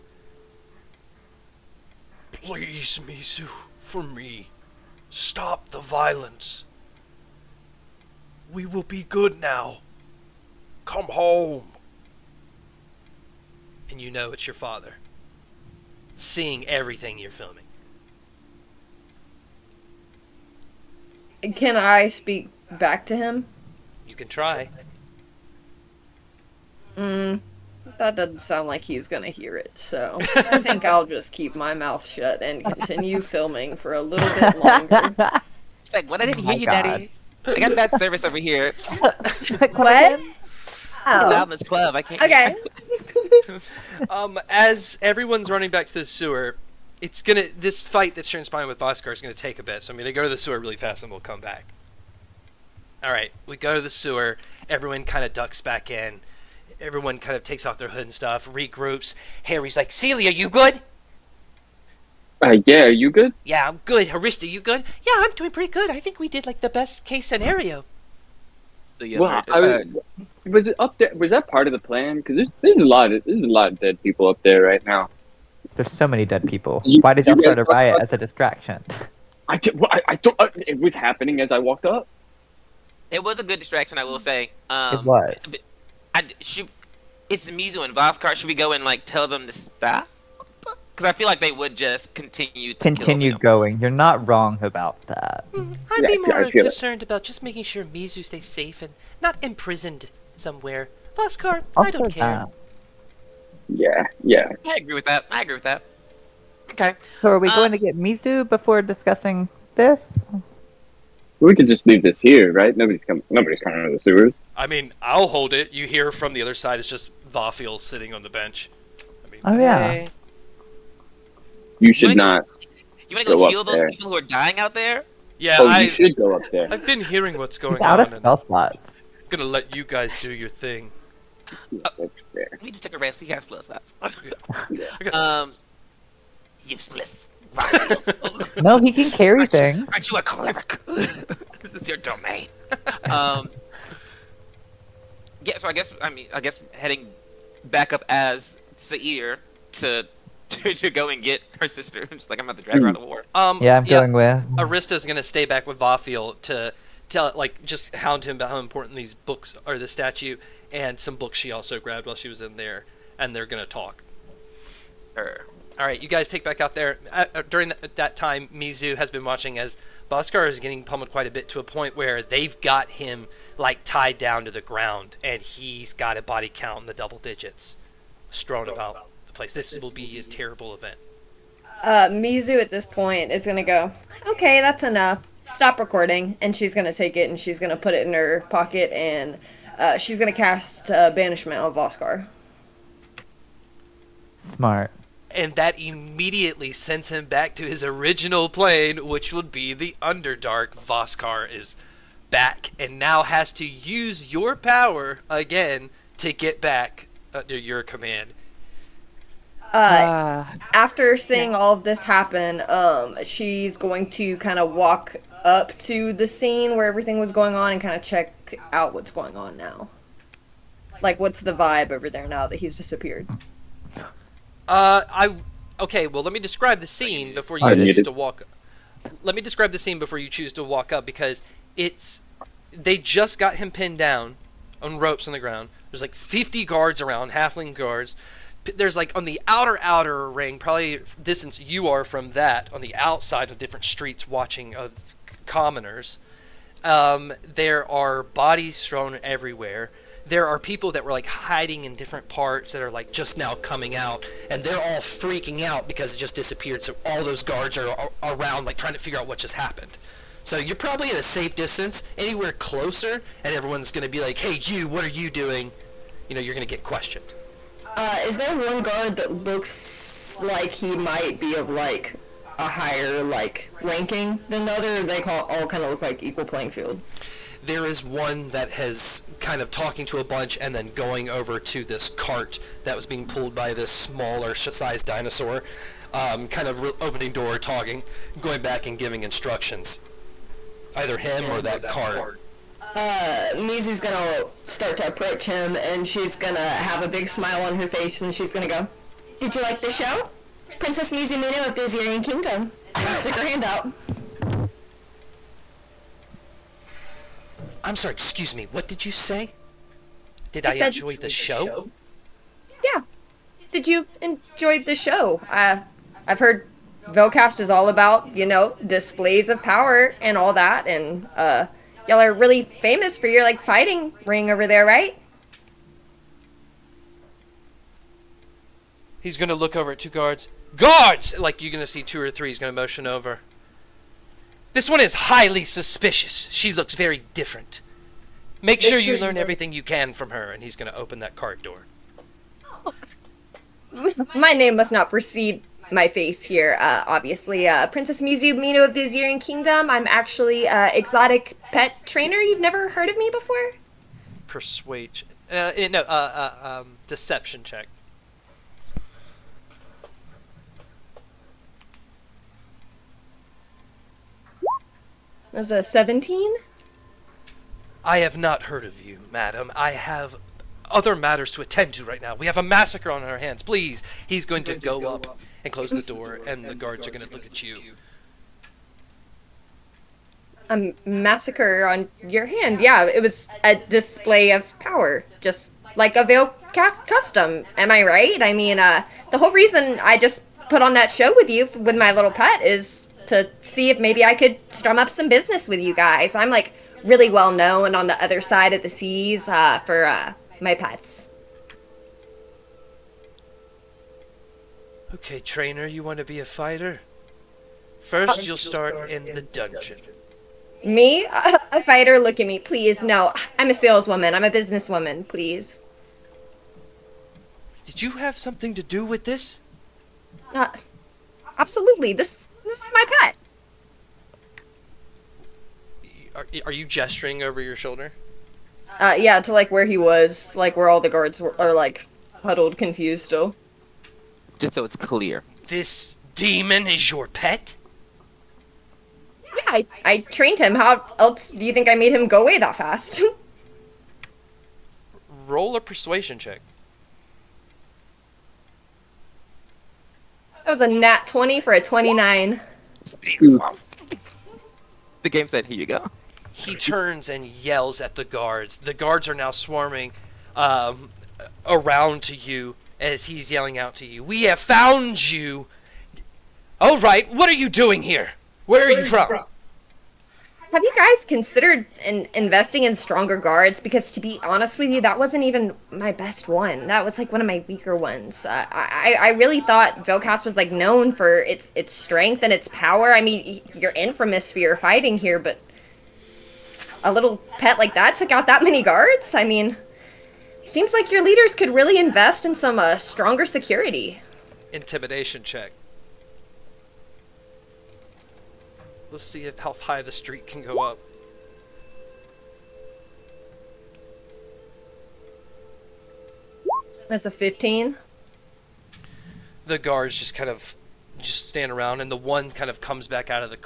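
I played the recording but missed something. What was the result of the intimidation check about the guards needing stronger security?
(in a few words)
15.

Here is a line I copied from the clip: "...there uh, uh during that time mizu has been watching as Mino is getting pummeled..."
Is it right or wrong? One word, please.
wrong.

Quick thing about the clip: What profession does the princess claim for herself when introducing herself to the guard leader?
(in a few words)
Exotic pet trainer.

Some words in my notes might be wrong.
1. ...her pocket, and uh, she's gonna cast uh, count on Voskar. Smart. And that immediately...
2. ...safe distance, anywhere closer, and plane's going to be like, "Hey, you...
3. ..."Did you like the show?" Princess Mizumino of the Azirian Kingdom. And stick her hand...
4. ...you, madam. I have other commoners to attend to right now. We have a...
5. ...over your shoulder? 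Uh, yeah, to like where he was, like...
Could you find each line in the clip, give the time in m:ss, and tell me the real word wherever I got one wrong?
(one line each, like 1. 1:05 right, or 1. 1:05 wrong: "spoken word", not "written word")
1. 3:08 wrong: "banishment", not "count"
2. 4:21 wrong: "everyone", not "plane"
3. 4:59 right
4. 6:09 wrong: "matters", not "commoners"
5. 7:07 right.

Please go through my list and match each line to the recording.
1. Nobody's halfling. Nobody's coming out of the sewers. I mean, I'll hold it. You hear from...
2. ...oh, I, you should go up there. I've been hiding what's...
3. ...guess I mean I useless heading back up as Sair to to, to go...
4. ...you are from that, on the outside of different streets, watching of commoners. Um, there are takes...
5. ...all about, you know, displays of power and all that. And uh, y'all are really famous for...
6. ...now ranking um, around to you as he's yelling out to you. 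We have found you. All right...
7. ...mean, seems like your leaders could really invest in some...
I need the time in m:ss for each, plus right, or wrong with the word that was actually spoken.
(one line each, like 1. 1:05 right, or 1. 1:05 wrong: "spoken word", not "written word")
1. 1:52 wrong: "coming", not "halfling"
2. 2:05 wrong: "hearing", not "hiding"
3. 2:25 wrong: "guess", not "useless"
4. 4:01 wrong: "bodies", not "takes"
5. 5:17 right
6. 7:39 wrong: "swarming", not "ranking"
7. 8:09 right.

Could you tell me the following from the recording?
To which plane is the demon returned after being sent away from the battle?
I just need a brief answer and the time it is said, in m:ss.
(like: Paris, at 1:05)
The Underdark, at 3:19.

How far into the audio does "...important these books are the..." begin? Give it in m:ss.
2:38.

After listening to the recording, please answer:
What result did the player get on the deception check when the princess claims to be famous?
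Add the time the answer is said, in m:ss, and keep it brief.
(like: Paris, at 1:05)
17, at 6:05.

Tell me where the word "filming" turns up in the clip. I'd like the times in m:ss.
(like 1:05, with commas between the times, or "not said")
0:17, 0:33.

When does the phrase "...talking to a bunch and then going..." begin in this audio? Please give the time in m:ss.
4:39.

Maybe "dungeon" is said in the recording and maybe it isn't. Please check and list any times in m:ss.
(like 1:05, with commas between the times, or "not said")
6:49.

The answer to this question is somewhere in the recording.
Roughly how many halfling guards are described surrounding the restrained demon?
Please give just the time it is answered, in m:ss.
3:56.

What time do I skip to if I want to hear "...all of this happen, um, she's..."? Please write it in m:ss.
3:31.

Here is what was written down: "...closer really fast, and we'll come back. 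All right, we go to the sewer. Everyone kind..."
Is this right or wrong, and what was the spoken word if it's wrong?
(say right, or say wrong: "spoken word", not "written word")
wrong: "sewer", not "closer".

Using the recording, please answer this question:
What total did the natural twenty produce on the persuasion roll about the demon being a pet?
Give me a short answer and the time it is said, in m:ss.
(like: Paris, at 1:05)
29, at 7:31.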